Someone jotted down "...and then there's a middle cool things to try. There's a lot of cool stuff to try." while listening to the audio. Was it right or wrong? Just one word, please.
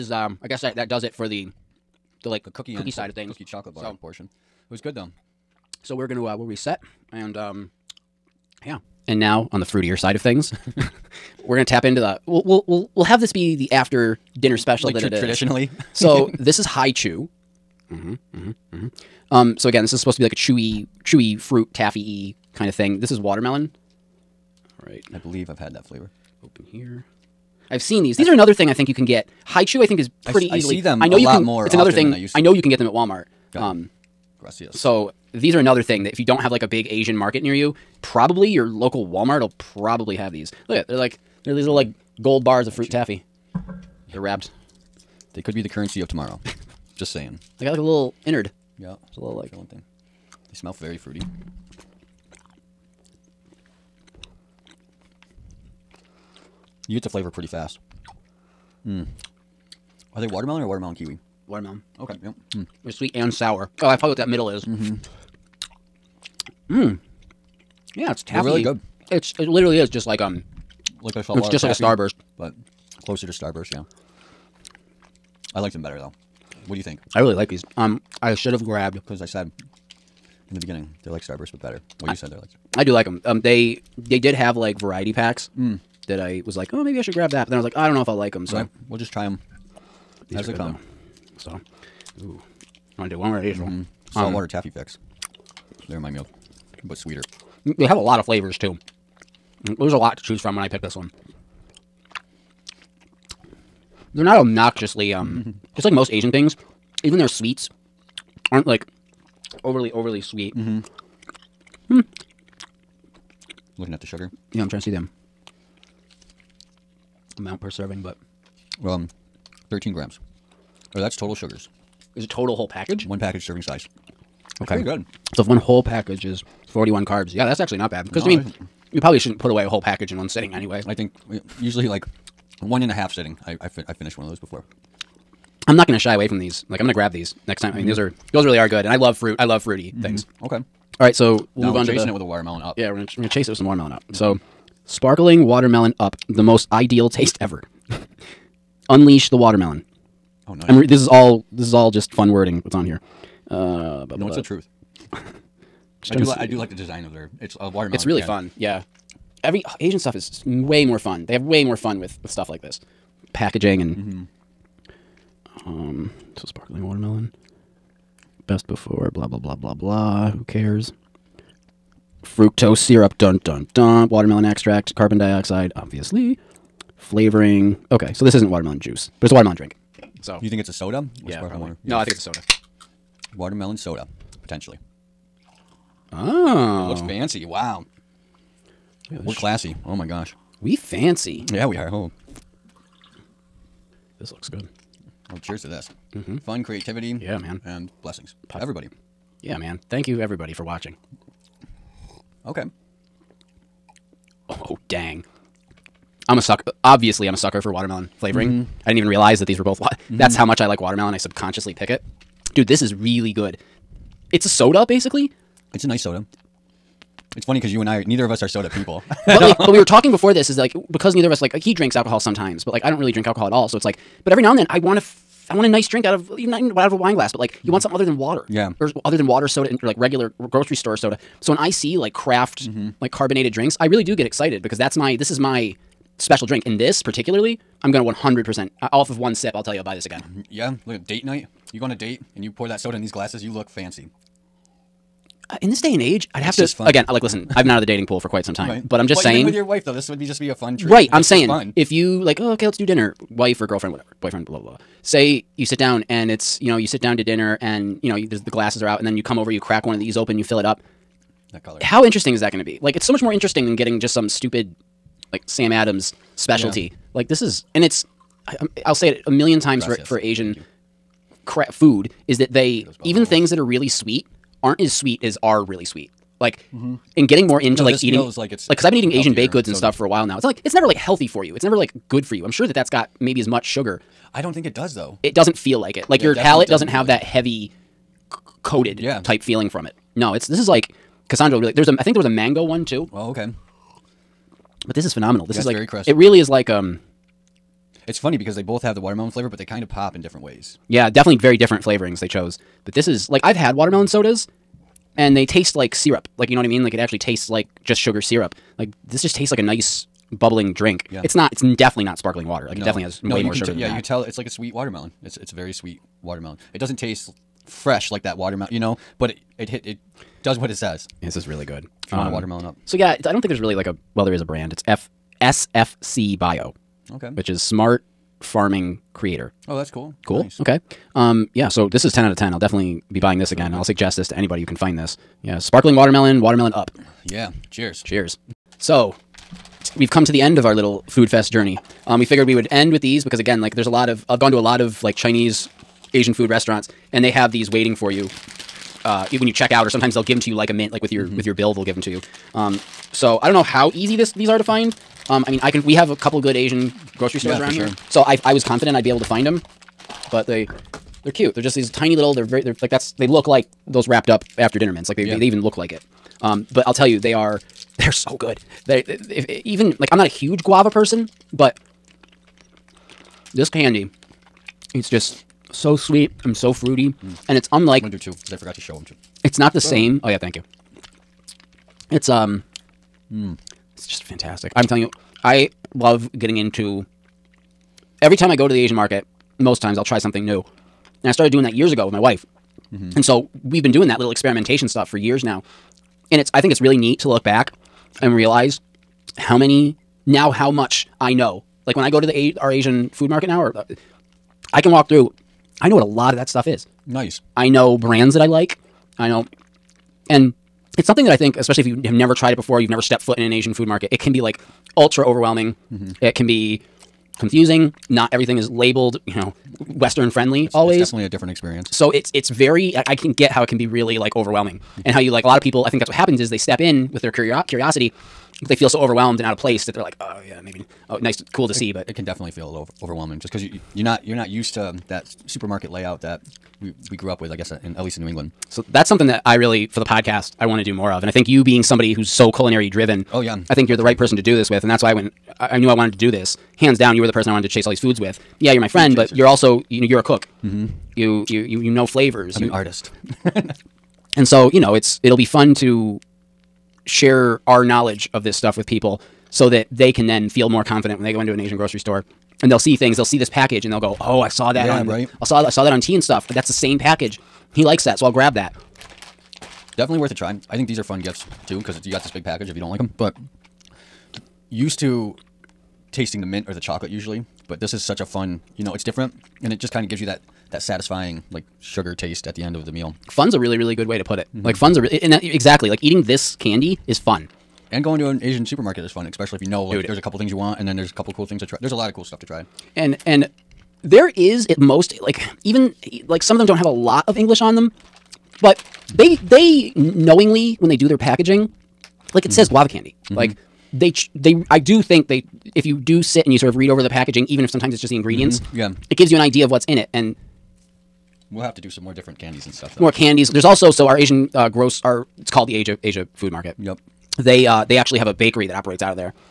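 wrong.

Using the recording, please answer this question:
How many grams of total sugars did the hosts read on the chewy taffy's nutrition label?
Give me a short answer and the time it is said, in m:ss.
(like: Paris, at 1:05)
13 grams, at 1:59.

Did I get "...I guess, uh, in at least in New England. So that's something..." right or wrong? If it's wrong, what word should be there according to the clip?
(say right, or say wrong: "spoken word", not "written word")
right.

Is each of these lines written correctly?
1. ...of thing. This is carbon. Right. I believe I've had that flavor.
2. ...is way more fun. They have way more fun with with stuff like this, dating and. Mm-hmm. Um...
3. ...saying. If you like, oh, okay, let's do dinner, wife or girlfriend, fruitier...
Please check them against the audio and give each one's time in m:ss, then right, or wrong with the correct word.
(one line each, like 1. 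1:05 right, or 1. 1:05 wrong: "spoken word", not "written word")
1. 0:22 wrong: "watermelon", not "carbon"
2. 2:40 wrong: "packaging", not "dating"
3. 4:11 wrong: "whatever", not "fruitier".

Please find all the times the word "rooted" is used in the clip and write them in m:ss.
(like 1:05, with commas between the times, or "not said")
not said.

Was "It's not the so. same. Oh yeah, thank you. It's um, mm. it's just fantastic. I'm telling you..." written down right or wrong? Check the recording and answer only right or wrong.
right.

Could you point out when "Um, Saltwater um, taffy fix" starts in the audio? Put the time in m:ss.
1:34.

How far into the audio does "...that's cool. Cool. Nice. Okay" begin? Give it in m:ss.
5:29.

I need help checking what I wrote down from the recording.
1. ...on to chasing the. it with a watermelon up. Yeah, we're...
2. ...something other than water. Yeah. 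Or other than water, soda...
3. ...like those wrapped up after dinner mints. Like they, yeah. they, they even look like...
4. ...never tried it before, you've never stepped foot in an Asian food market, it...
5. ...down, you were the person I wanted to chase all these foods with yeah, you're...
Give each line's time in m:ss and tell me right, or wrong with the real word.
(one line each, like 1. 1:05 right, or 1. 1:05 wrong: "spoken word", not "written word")
1. 2:21 right
2. 3:47 right
3. 6:03 right
4. 6:52 right
5. 7:26 right.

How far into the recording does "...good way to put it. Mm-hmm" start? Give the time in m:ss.
8:03.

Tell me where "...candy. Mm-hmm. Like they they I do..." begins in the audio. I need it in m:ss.
8:22.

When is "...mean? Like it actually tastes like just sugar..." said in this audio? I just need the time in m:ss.
5:06.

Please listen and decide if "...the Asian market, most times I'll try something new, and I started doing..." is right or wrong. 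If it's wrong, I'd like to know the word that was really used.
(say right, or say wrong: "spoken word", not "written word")
right.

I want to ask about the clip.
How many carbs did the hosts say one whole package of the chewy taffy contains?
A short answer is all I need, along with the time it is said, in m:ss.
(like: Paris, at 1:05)
41, at 2:06.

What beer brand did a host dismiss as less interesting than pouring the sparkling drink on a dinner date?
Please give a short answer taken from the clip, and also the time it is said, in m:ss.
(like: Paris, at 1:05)
Sam Adams, at 4:25.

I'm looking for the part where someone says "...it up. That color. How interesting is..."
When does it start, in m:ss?
4:20.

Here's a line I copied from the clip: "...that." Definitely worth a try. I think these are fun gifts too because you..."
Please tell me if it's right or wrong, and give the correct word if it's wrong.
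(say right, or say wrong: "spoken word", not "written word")
right.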